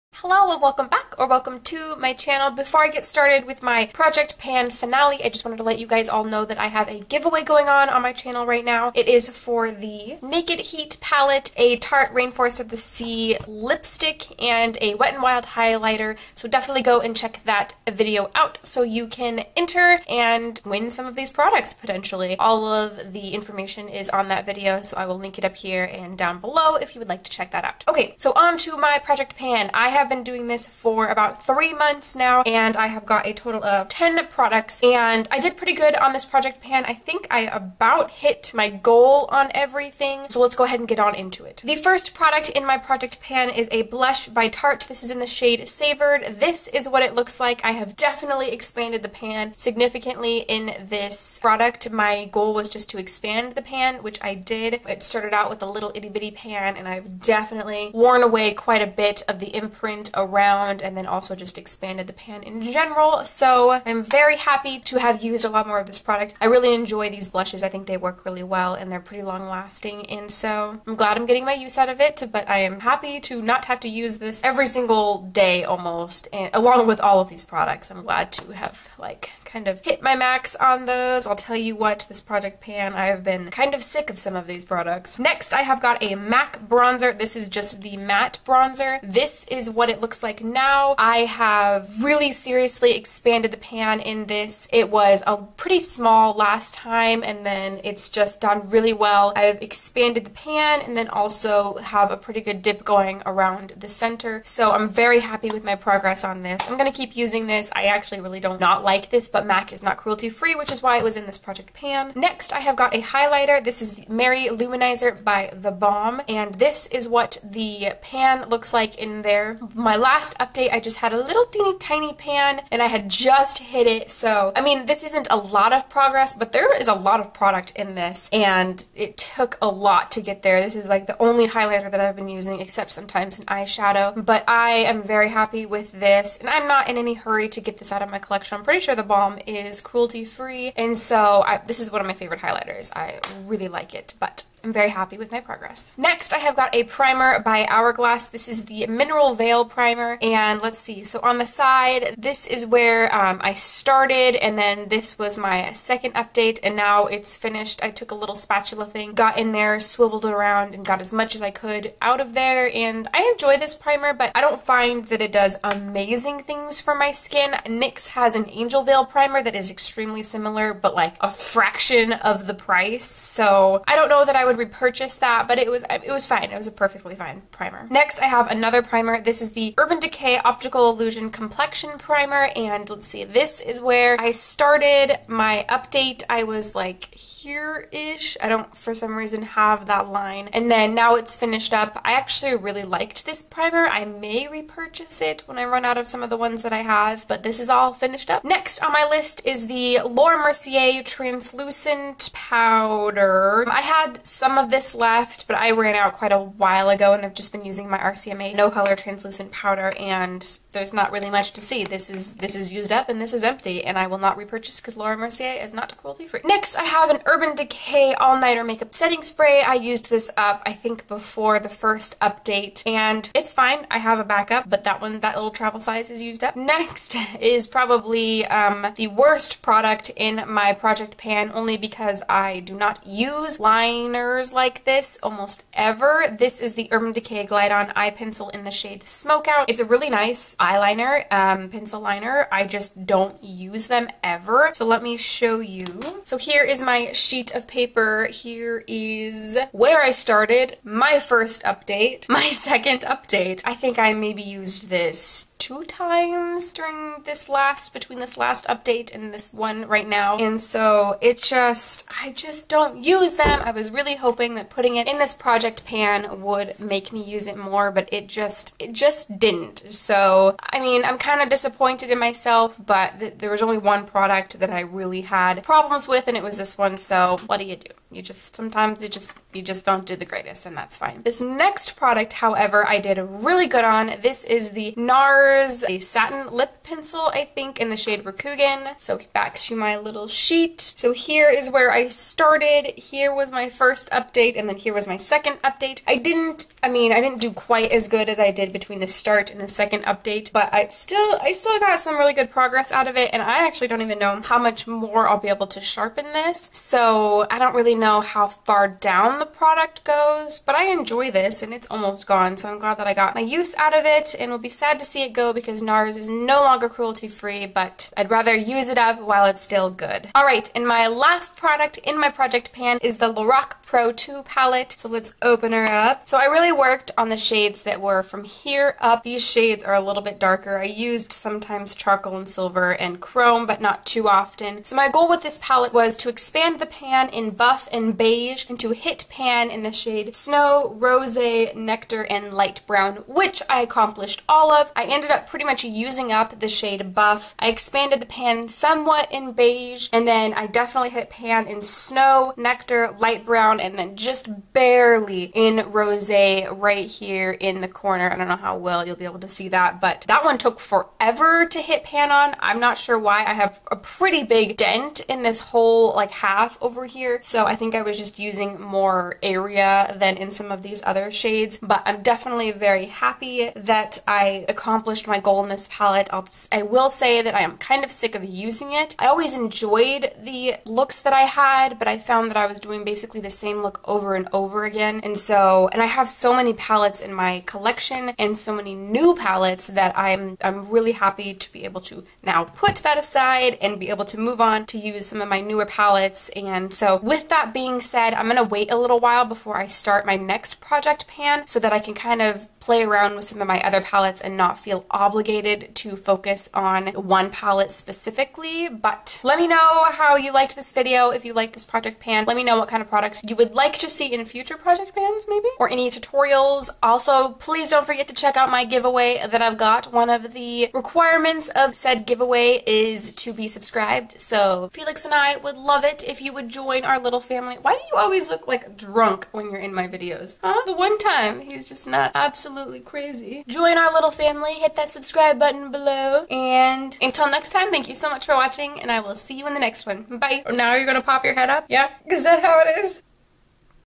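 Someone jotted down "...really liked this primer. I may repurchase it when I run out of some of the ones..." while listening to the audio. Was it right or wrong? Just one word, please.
right.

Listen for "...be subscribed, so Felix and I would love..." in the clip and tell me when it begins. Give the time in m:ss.
7:03.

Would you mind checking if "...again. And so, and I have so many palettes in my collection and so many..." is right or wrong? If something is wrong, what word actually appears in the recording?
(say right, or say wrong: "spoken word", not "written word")
right.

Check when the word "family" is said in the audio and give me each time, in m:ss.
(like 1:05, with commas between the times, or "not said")
7:07, 7:14.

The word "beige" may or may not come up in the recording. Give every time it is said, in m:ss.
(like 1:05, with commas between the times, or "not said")
5:38, 5:49.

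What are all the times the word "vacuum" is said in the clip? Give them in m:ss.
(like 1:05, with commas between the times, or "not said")
not said.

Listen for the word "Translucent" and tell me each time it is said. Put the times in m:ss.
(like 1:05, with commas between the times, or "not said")
3:21, 3:28.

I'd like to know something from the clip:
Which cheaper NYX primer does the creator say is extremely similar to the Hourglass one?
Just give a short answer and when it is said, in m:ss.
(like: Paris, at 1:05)
Angel Veil Primer, at 2:48.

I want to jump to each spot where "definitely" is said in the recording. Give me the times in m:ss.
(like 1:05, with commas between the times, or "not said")
0:16, 0:47, 0:57, 5:50, 6:12.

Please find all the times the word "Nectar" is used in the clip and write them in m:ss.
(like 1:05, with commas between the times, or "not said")
5:41, 5:52.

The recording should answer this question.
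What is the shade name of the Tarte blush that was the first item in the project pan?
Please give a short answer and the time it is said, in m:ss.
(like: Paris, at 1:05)
Savored, at 0:45.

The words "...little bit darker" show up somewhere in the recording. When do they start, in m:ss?
5:30.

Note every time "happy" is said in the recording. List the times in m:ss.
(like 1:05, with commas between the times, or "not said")
1:04, 1:12, 1:45, 2:15, 2:24, 6:13, 6:31.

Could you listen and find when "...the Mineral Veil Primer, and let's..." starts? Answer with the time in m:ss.
2:28.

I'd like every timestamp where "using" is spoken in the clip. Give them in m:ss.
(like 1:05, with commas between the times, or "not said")
1:47, 2:12, 3:27, 5:45, 6:08, 6:18.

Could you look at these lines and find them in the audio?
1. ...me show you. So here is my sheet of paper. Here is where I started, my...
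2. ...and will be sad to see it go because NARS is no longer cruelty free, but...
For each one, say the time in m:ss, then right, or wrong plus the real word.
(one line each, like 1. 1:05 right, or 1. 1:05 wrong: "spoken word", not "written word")
1. 4:05 right
2. 5:14 right.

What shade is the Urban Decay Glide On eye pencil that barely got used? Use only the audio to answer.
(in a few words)
Smoke Out.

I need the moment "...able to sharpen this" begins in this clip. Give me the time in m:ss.
5:05.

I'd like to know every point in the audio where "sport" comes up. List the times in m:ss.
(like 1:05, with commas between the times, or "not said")
not said.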